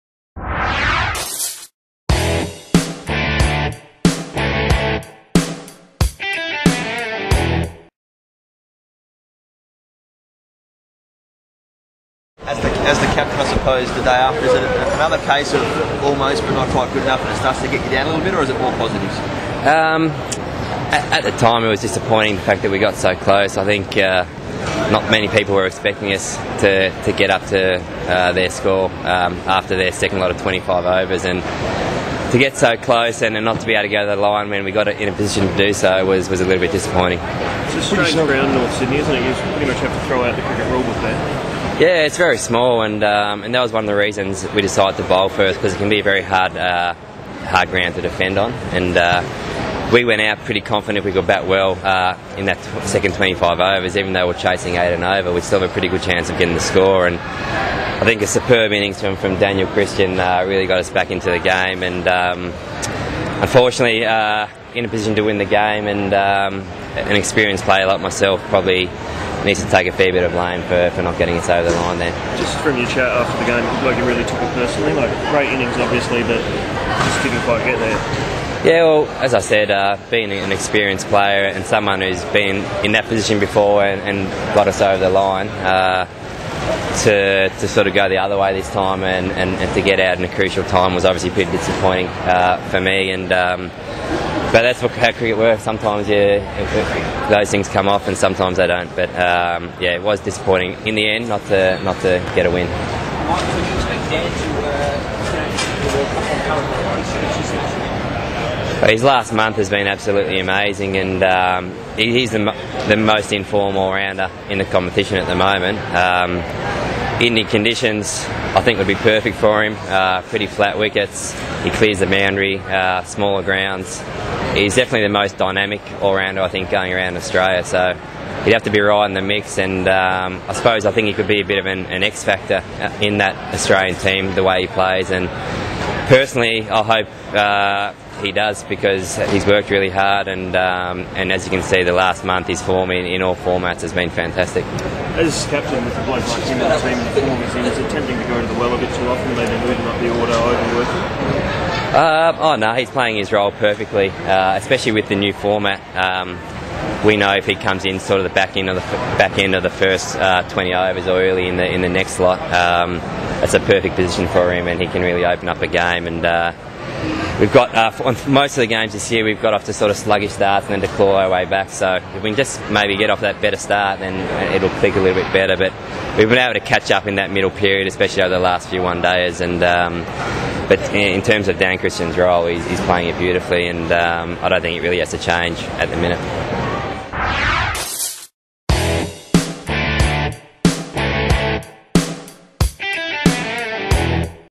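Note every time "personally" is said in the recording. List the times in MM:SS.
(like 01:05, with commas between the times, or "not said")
01:14, 02:16.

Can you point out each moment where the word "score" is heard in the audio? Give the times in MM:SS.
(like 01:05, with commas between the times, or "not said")
00:28, 00:56.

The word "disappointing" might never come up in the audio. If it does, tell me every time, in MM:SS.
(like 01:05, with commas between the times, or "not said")
00:21, 00:36, 01:31, 01:40.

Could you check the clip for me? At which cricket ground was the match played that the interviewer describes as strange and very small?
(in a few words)
North Sydney.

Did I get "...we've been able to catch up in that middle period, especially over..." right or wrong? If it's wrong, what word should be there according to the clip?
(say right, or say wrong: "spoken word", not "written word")
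right.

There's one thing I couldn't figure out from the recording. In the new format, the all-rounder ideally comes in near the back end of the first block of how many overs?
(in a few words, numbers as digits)
20.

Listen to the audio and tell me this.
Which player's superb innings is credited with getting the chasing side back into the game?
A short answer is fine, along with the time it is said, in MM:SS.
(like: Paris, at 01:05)
Daniel Christian, at 00:59.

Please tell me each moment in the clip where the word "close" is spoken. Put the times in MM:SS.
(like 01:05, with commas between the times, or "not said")
00:23, 00:32.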